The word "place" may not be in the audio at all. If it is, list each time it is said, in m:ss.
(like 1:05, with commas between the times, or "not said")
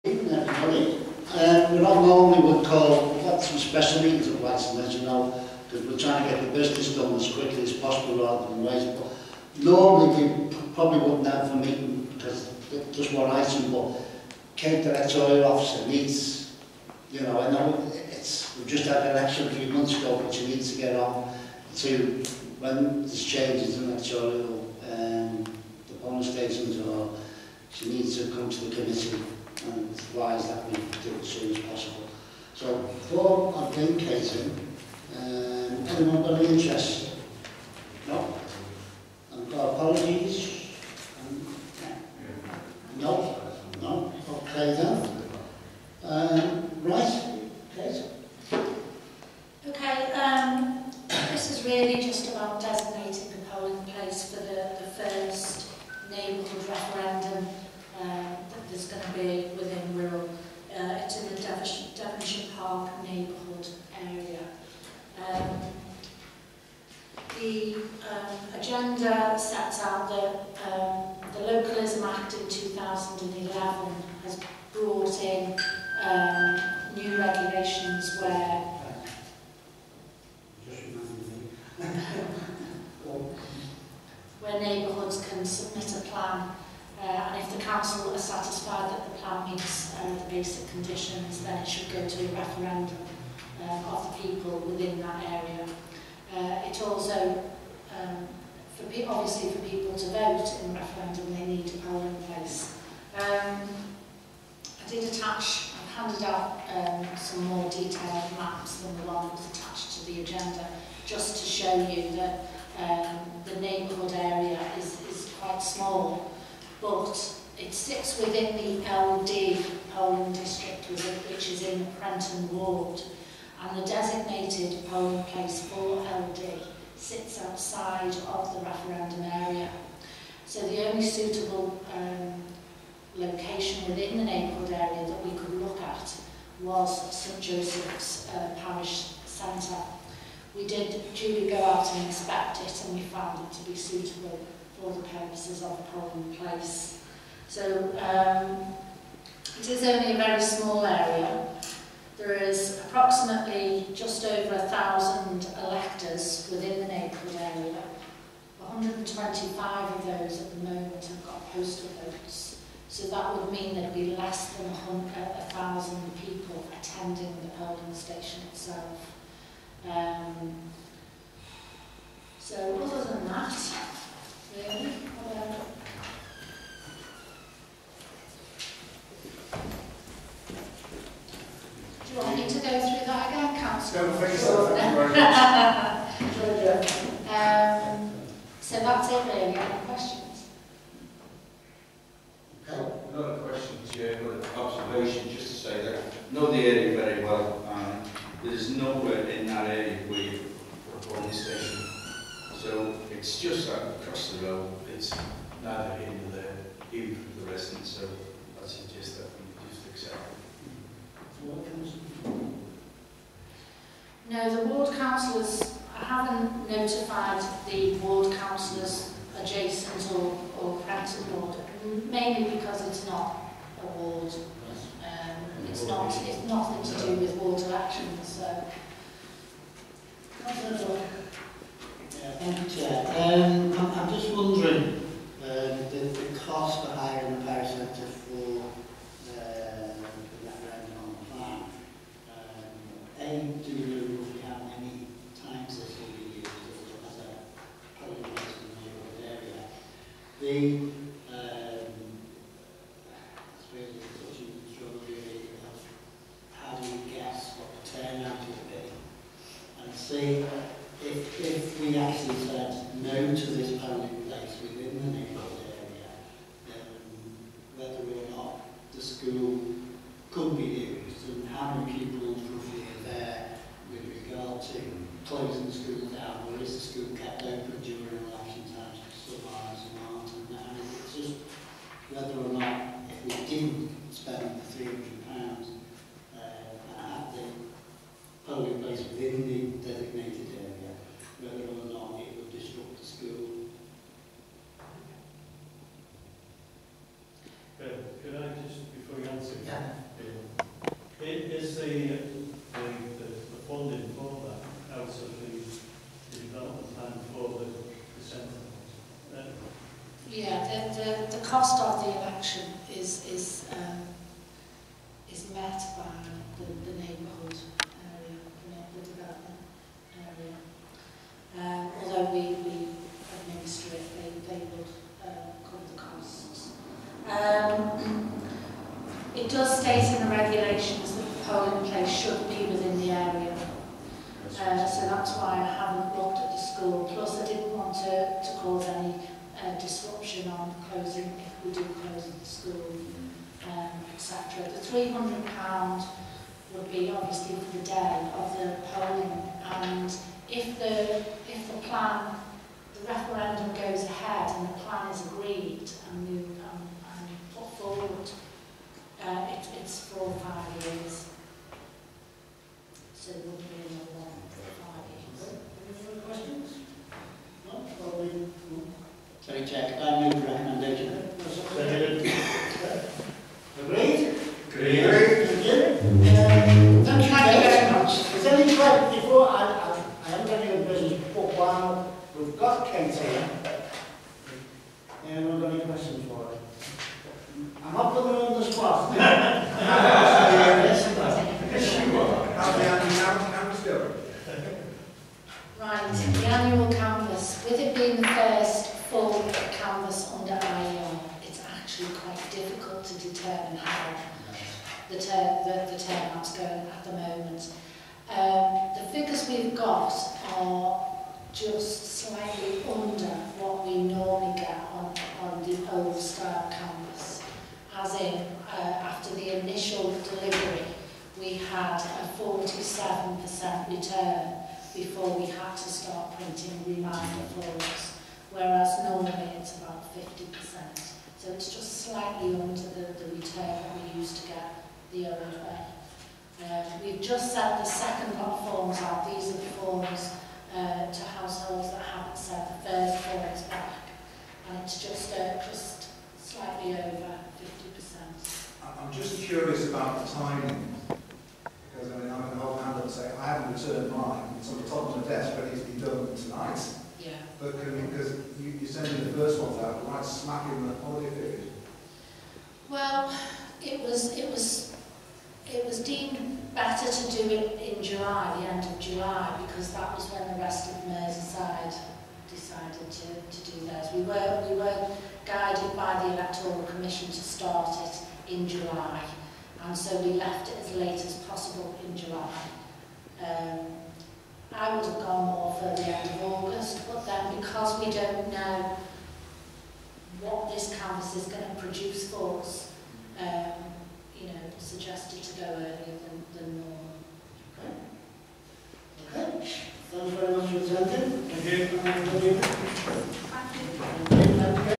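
1:42, 2:05, 2:26.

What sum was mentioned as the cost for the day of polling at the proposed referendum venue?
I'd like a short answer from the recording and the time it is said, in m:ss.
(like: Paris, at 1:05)
£300, at 5:44.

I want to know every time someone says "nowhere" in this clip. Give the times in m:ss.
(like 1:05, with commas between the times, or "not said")
3:18.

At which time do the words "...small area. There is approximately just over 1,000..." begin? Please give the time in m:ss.
2:30.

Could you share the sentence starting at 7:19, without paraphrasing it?
These are the forms uh, to households that haven't sent the first forms back.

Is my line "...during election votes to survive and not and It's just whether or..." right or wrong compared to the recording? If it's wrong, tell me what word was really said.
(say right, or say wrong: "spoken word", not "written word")
wrong: "times", not "votes".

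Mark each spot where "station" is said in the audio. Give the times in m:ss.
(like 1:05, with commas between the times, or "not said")
0:26, 2:47, 3:21.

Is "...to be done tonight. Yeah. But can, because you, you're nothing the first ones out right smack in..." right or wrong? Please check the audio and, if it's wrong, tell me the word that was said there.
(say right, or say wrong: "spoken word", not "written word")
wrong: "sending", not "nothing".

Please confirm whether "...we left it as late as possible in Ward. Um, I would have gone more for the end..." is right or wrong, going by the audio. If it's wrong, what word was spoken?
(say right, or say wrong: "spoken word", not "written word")
wrong: "July", not "Ward".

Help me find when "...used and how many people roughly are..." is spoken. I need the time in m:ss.
4:30.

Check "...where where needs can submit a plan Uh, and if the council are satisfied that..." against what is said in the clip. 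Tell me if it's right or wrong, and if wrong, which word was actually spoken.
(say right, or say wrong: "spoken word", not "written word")
wrong: "neighbourhoods", not "needs".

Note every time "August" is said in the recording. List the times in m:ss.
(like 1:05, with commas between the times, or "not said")
8:06.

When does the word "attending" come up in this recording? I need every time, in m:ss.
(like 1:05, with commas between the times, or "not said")
2:46, 8:21.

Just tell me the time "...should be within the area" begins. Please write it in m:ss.
5:32.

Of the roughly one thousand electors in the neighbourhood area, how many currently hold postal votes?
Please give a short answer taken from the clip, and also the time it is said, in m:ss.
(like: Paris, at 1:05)
125, at 2:38.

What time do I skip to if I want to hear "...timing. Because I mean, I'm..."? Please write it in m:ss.
7:30.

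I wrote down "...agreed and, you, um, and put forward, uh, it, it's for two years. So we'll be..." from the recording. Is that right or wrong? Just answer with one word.
wrong.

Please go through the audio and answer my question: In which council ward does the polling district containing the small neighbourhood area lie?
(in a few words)
Prenton.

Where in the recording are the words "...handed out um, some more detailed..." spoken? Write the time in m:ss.
1:46.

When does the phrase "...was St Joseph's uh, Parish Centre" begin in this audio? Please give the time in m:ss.
2:16.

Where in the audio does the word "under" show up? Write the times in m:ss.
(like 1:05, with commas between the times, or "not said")
6:40, 7:12.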